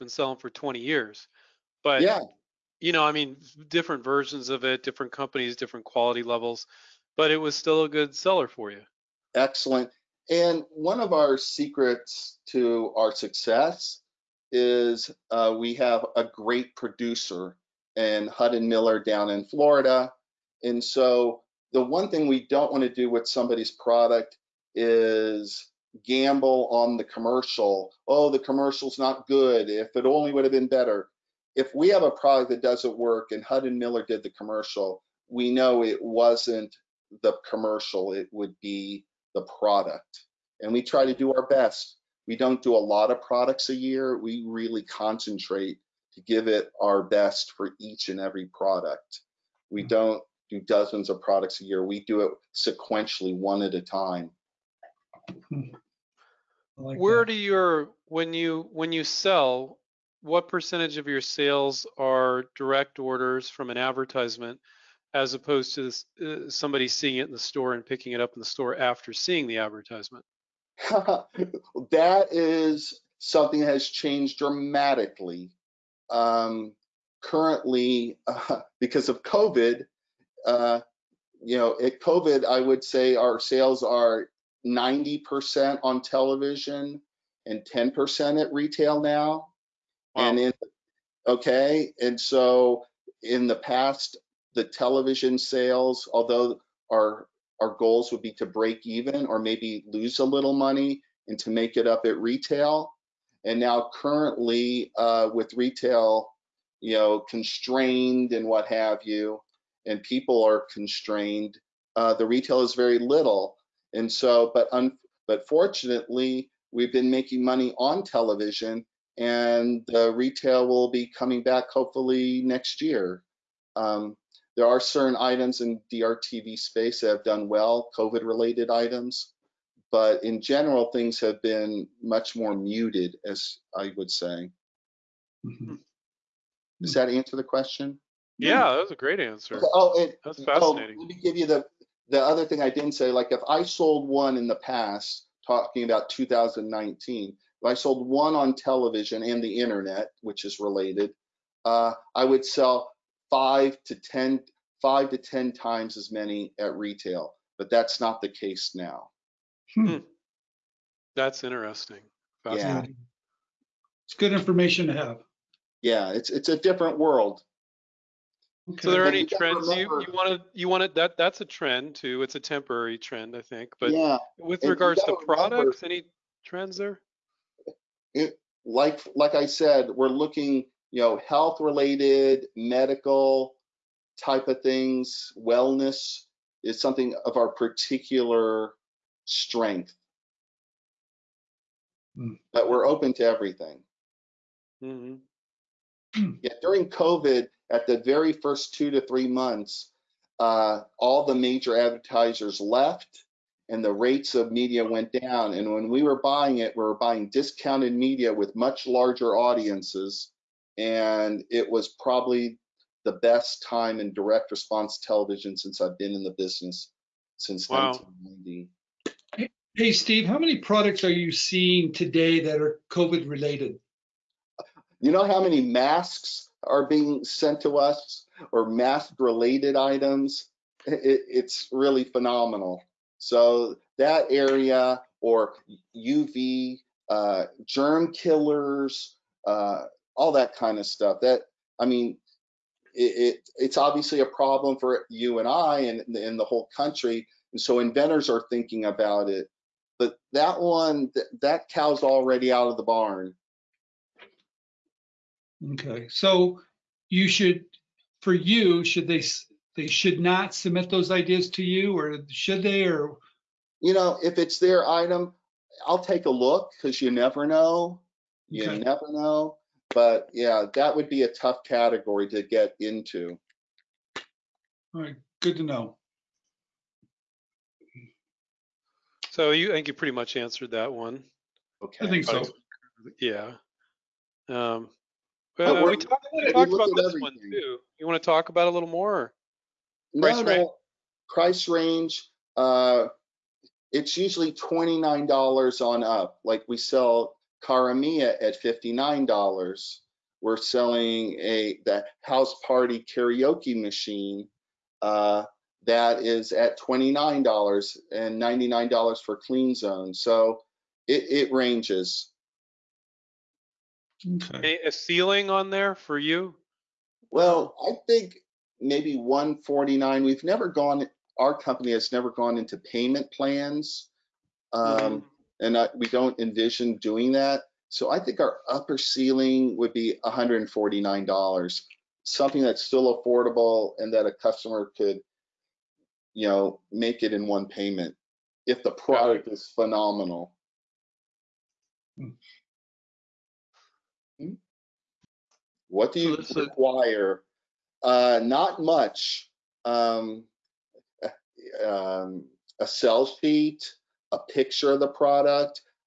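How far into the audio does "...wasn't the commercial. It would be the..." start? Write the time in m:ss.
0:36.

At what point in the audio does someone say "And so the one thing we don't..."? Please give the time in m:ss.
0:20.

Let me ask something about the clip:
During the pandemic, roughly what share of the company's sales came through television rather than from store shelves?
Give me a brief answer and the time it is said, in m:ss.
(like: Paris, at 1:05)
90%, at 1:24.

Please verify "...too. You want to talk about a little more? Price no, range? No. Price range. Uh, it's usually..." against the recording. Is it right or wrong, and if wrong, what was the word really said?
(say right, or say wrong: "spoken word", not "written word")
right.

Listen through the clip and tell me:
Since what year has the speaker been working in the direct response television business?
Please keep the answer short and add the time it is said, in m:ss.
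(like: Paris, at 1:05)
1990, at 3:37.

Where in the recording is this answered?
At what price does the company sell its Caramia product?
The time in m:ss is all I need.
4:58.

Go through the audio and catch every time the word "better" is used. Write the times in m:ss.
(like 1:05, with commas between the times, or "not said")
0:30.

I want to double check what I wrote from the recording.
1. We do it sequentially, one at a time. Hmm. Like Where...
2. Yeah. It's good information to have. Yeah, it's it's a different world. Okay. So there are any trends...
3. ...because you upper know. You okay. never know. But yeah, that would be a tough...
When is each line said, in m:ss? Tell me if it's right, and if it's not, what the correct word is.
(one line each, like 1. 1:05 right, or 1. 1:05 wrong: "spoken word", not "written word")
1. 0:51 right
2. 2:42 right
3. 4:26 wrong: "never", not "upper".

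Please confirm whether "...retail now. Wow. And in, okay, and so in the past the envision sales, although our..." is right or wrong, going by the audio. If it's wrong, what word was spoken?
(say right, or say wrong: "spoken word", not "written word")
wrong: "television", not "envision".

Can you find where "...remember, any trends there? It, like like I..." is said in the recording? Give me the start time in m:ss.
2:55.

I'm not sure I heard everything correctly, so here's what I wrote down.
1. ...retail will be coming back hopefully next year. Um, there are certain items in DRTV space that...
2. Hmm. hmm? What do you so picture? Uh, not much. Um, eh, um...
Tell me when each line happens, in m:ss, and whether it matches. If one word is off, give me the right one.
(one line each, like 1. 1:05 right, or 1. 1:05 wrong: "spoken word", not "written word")
1. 2:00 right
2. 5:42 wrong: "require", not "picture".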